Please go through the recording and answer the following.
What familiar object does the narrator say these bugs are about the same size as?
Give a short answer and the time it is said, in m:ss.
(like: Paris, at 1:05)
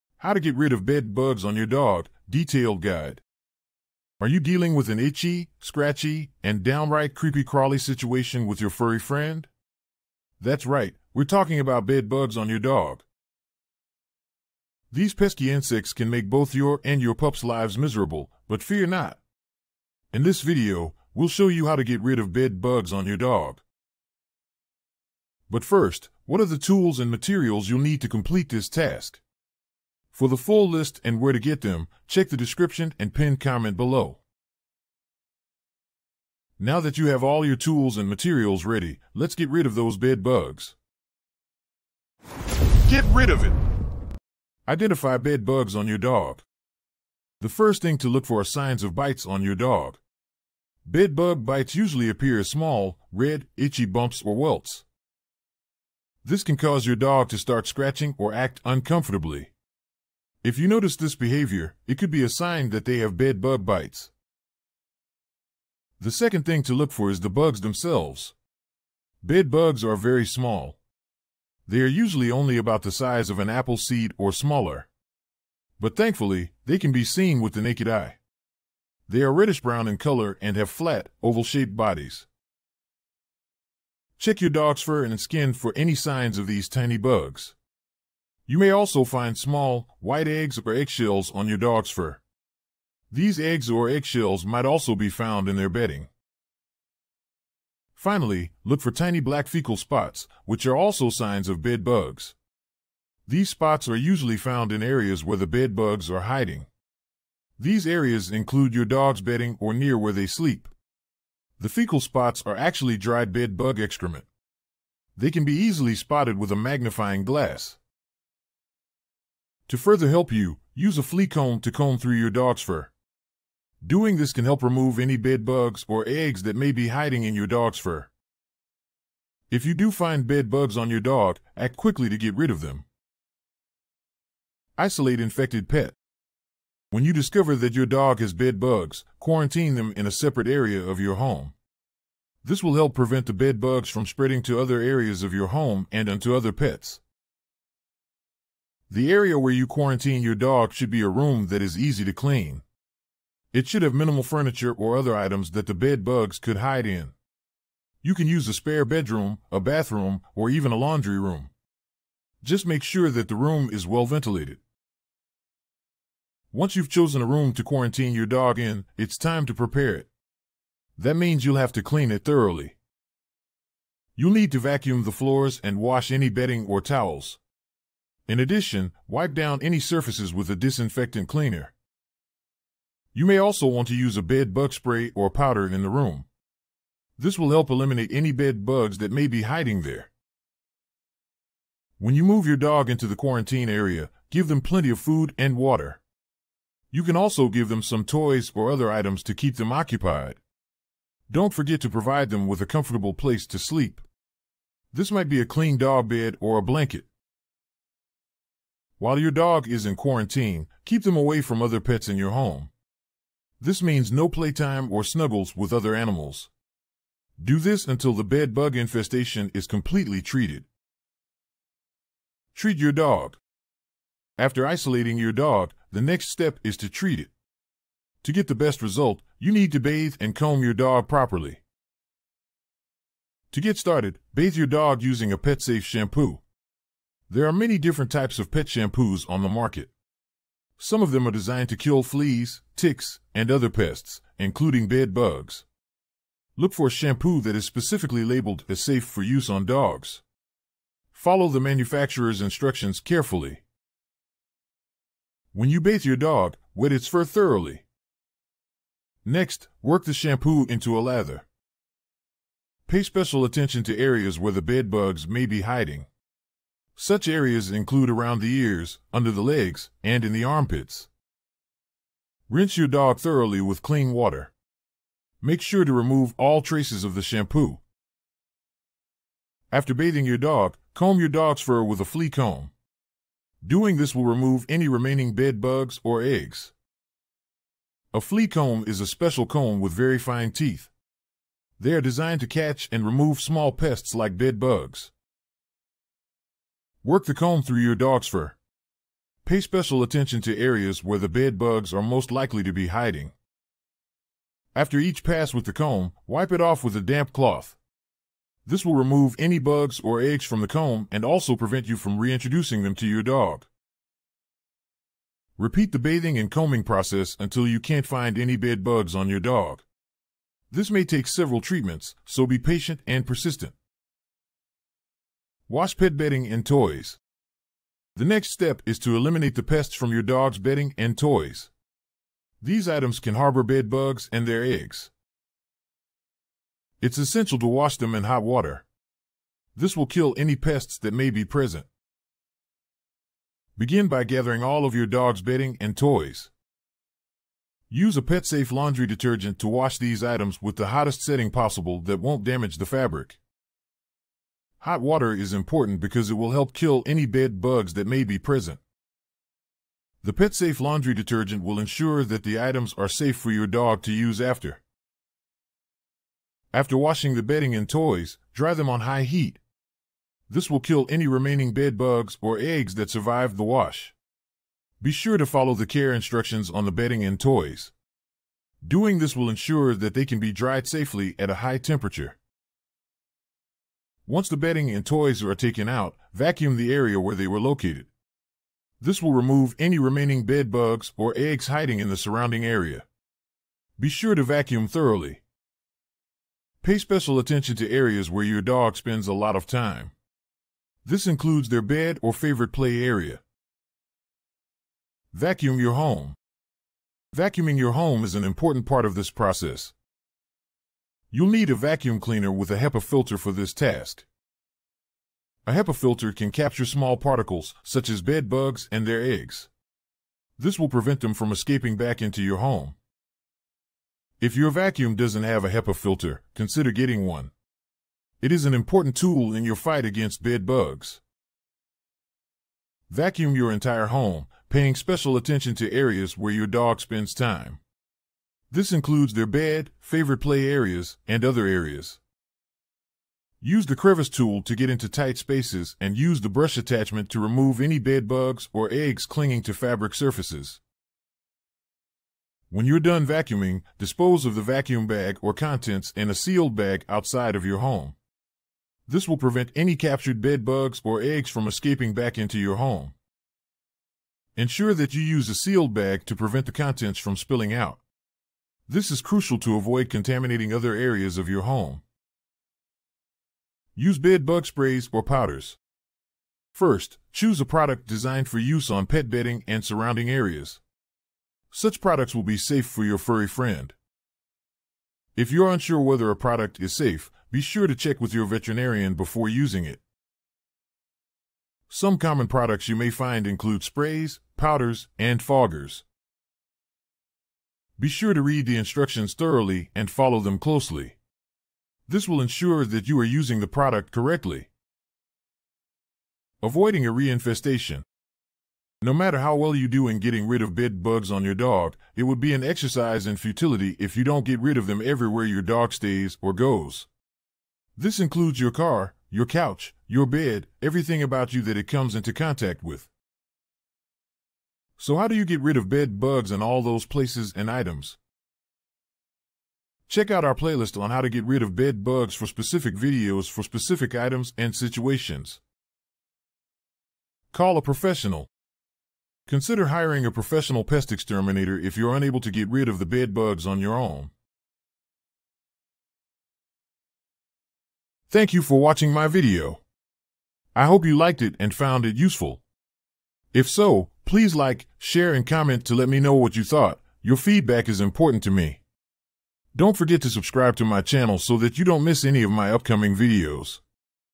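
An apple seed, at 1:13.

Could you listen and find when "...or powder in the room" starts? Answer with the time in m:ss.
3:05.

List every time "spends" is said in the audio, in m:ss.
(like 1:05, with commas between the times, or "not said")
6:38, 7:16.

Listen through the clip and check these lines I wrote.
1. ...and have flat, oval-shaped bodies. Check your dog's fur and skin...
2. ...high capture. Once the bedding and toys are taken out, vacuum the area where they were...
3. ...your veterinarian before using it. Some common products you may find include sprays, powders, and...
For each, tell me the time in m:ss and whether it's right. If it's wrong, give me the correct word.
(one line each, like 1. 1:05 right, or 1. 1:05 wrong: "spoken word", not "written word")
1. 1:20 right
2. 6:21 wrong: "temperature", not "capture"
3. 8:08 right.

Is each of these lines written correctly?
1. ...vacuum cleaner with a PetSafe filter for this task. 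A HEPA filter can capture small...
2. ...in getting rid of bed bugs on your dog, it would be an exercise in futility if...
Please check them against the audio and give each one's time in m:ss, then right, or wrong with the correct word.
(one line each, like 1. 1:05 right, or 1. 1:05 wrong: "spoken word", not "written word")
1. 6:51 wrong: "HEPA", not "PetSafe"
2. 8:30 right.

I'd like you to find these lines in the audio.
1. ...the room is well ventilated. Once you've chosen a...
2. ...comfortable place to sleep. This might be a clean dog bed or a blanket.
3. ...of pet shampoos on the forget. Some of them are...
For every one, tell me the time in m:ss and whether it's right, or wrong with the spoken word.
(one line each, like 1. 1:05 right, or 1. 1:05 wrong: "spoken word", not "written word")
1. 2:43 right
2. 3:22 right
3. 3:58 wrong: "market", not "forget".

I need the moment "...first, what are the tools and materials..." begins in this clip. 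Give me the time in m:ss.
0:25.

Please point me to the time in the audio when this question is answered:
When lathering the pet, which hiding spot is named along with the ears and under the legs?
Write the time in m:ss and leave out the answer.
4:30.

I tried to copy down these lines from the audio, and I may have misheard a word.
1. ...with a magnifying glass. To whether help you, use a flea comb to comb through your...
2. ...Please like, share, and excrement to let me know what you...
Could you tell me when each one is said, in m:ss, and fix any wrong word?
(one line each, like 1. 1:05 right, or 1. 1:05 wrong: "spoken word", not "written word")
1. 1:56 wrong: "further", not "whether"
2. 9:14 wrong: "comment", not "excrement".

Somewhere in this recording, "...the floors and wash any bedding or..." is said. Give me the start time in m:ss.
2:55.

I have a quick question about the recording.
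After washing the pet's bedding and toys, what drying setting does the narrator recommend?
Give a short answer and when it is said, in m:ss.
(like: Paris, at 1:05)
High heat, at 6:09.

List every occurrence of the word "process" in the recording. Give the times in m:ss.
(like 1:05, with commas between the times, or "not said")
5:16, 6:49.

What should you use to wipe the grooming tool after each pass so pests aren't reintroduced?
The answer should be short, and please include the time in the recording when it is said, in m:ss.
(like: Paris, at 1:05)
A damp cloth, at 5:07.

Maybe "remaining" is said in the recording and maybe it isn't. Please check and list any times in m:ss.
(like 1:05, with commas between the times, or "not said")
4:44, 6:11, 6:29.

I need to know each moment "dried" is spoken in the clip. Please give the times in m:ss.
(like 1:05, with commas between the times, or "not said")
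1:52, 6:20.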